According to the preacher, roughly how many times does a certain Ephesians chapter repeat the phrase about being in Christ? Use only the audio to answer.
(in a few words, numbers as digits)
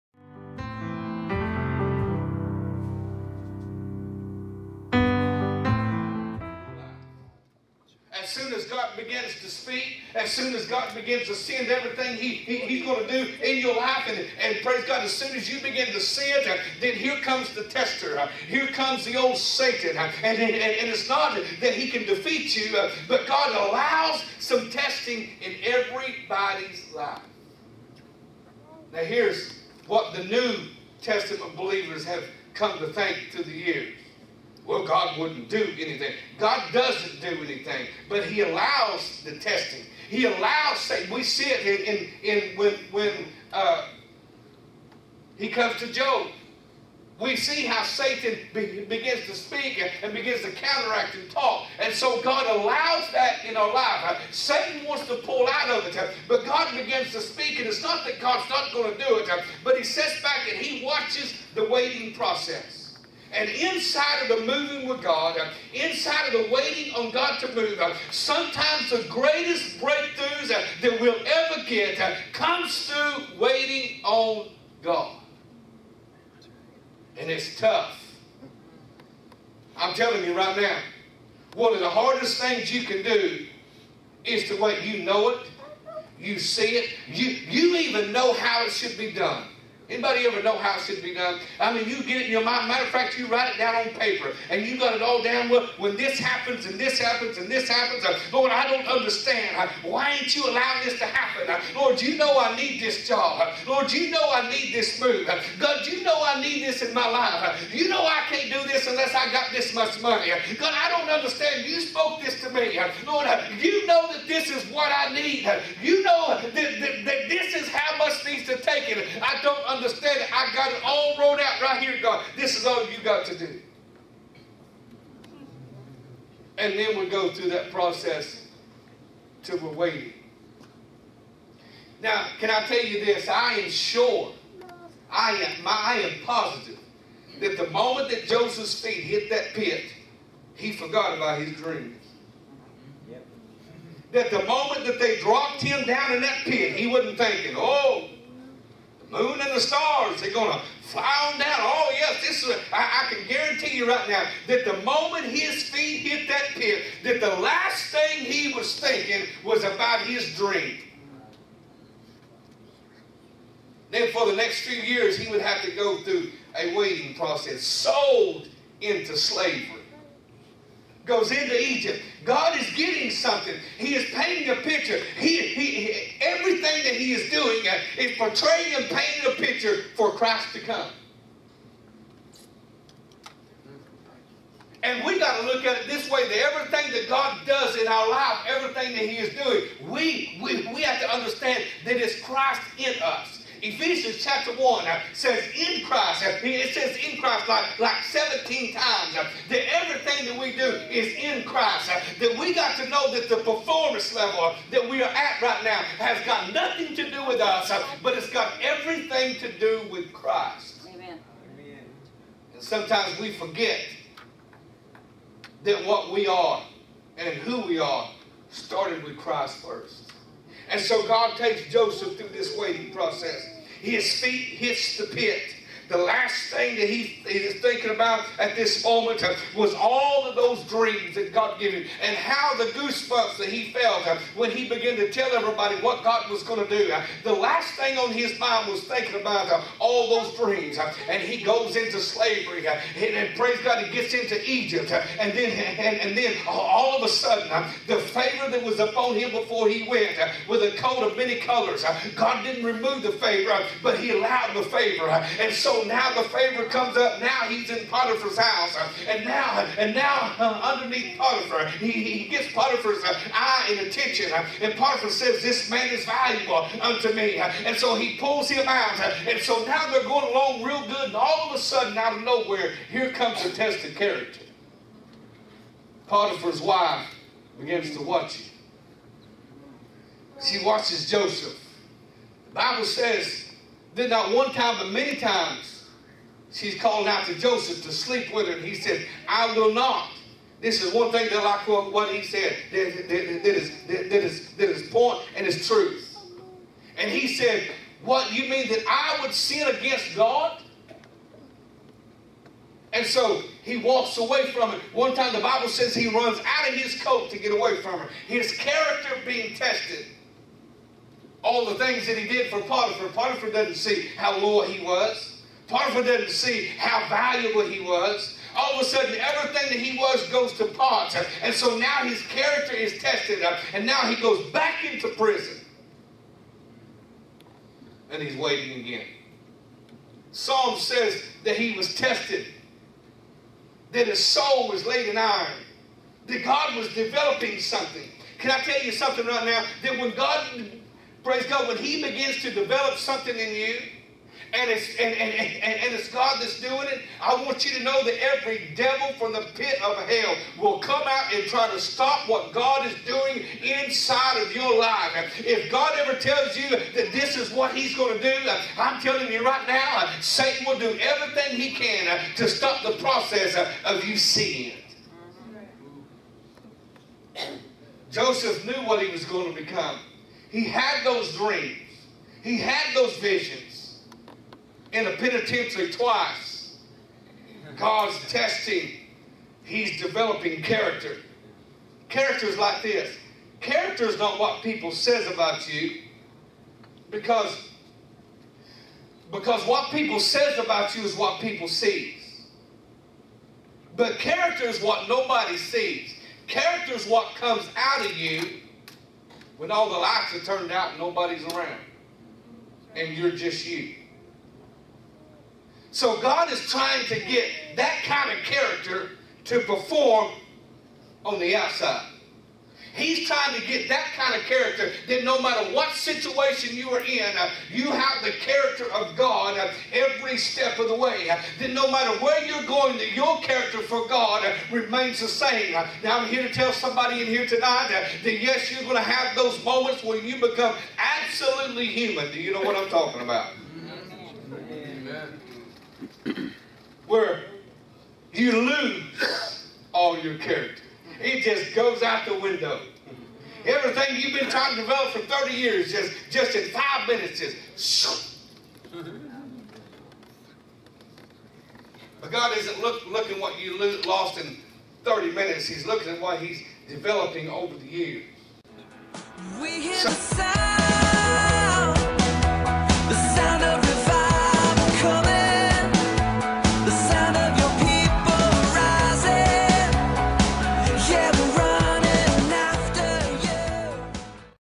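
17.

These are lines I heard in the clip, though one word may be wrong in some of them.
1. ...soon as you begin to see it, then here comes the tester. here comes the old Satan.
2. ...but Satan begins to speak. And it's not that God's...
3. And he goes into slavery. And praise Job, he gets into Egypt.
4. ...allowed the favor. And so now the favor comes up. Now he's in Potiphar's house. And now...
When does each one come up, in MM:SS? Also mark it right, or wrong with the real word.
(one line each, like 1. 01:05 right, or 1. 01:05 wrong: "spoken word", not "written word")
1. 00:15 right
2. 00:56 wrong: "God", not "Satan"
3. 04:01 wrong: "God", not "Job"
4. 04:14 right.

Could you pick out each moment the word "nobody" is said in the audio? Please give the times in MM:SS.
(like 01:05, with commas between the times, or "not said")
06:35, 06:40.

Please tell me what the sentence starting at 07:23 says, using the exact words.
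Everything you've been trying to develop for 30 years, just, just in five minutes, just shoo.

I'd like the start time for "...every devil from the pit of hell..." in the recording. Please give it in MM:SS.
05:48.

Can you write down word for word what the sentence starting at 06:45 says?
So God is trying to get that kind of character to perform on the outside.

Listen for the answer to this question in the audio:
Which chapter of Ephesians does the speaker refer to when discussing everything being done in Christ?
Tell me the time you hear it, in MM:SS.
03:14.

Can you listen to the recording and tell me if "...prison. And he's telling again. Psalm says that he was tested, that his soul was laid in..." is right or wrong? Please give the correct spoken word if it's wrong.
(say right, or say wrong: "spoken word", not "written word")
wrong: "waiting", not "telling".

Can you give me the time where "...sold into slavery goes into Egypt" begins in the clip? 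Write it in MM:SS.
02:47.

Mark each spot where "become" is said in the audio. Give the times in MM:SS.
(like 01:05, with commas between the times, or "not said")
06:09, 07:10.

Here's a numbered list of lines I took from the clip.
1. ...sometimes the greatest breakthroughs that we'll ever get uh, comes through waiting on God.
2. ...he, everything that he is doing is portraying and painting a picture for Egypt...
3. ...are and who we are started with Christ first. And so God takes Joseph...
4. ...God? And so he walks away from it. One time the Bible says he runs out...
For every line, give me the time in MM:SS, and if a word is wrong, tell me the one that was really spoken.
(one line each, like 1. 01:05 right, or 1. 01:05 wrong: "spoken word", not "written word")
1. 01:08 right
2. 02:55 wrong: "Christ", not "Egypt"
3. 03:36 right
4. 05:00 right.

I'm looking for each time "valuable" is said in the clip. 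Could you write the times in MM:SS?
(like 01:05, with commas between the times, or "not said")
04:26, 05:17.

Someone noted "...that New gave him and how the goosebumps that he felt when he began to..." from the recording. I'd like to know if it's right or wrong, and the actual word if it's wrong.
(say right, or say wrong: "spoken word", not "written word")
wrong: "God", not "New".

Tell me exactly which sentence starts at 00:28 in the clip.
Now, here's what the New Testament believers have come to think through the years well, God wouldn't do anything.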